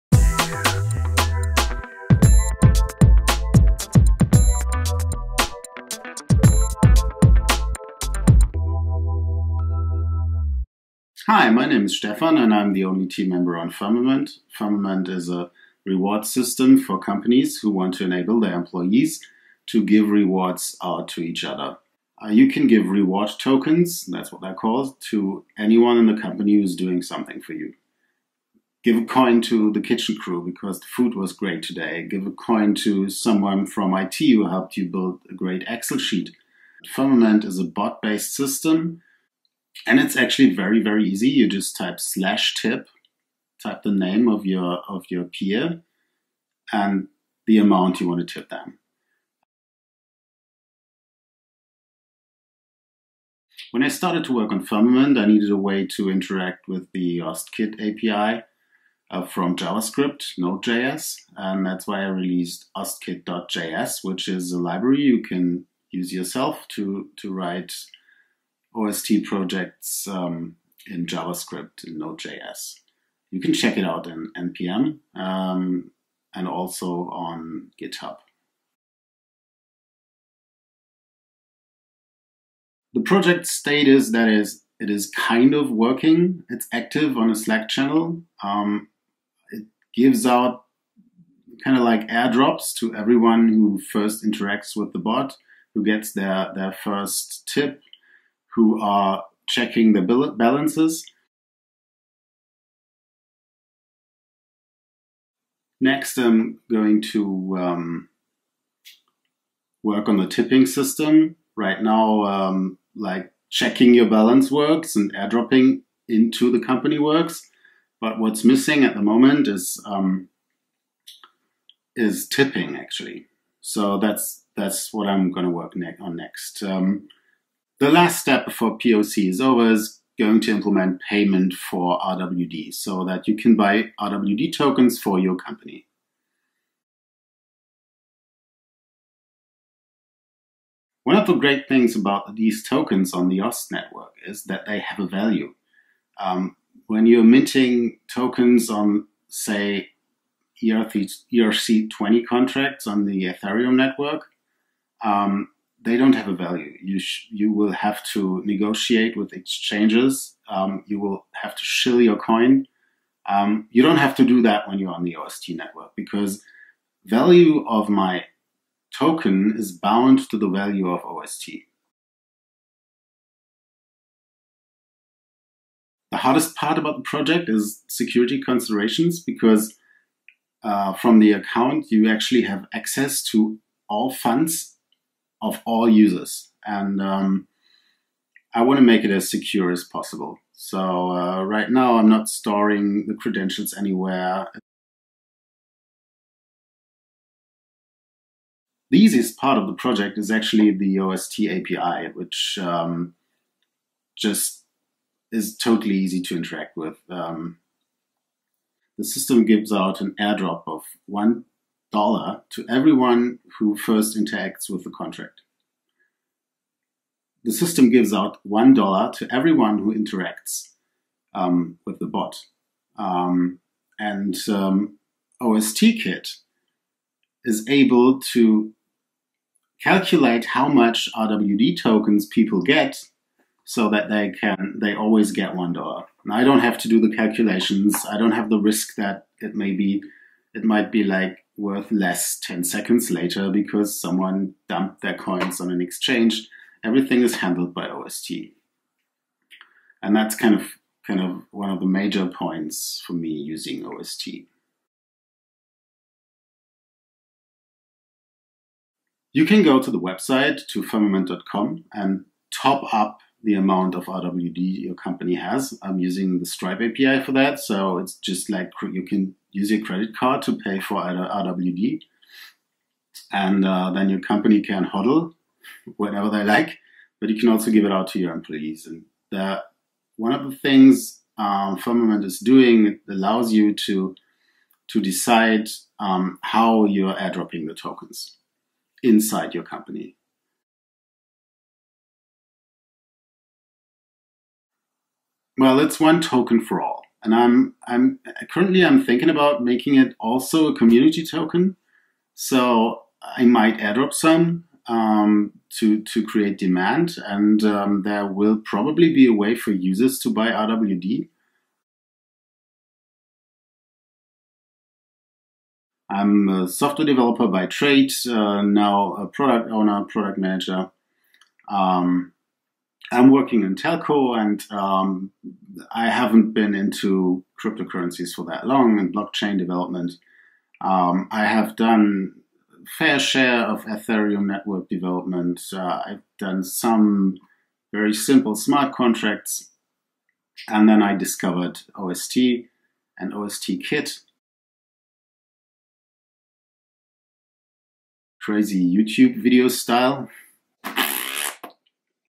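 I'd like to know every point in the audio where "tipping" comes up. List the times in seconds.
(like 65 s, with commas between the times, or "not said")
110 s, 122 s.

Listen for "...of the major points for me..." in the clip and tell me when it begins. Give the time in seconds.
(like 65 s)
251 s.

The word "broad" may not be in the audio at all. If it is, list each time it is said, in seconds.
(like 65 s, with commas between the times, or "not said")
not said.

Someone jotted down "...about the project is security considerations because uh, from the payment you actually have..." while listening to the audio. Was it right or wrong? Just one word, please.
wrong.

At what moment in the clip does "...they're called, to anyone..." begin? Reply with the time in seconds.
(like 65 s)
24 s.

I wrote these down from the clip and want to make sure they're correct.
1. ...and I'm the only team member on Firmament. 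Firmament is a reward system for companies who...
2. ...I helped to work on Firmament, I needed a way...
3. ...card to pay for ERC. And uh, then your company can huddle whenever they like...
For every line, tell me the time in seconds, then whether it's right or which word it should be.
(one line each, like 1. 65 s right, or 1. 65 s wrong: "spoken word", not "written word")
1. 12 s right
2. 53 s wrong: "started", not "helped"
3. 270 s wrong: "RWD", not "ERC".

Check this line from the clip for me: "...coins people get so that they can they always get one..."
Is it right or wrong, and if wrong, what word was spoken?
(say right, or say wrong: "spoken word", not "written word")
wrong: "tokens", not "coins".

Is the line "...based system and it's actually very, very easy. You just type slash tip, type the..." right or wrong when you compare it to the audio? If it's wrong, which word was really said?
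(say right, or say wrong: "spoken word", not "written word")
right.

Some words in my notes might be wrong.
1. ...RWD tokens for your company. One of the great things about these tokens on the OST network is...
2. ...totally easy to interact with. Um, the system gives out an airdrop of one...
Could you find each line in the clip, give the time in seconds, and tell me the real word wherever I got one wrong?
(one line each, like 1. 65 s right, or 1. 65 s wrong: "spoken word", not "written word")
1. 133 s right
2. 205 s right.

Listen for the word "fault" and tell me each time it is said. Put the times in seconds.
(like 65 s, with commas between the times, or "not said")
not said.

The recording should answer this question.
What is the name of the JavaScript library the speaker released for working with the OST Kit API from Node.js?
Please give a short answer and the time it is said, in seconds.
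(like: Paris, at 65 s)
ostkit.js, at 62 s.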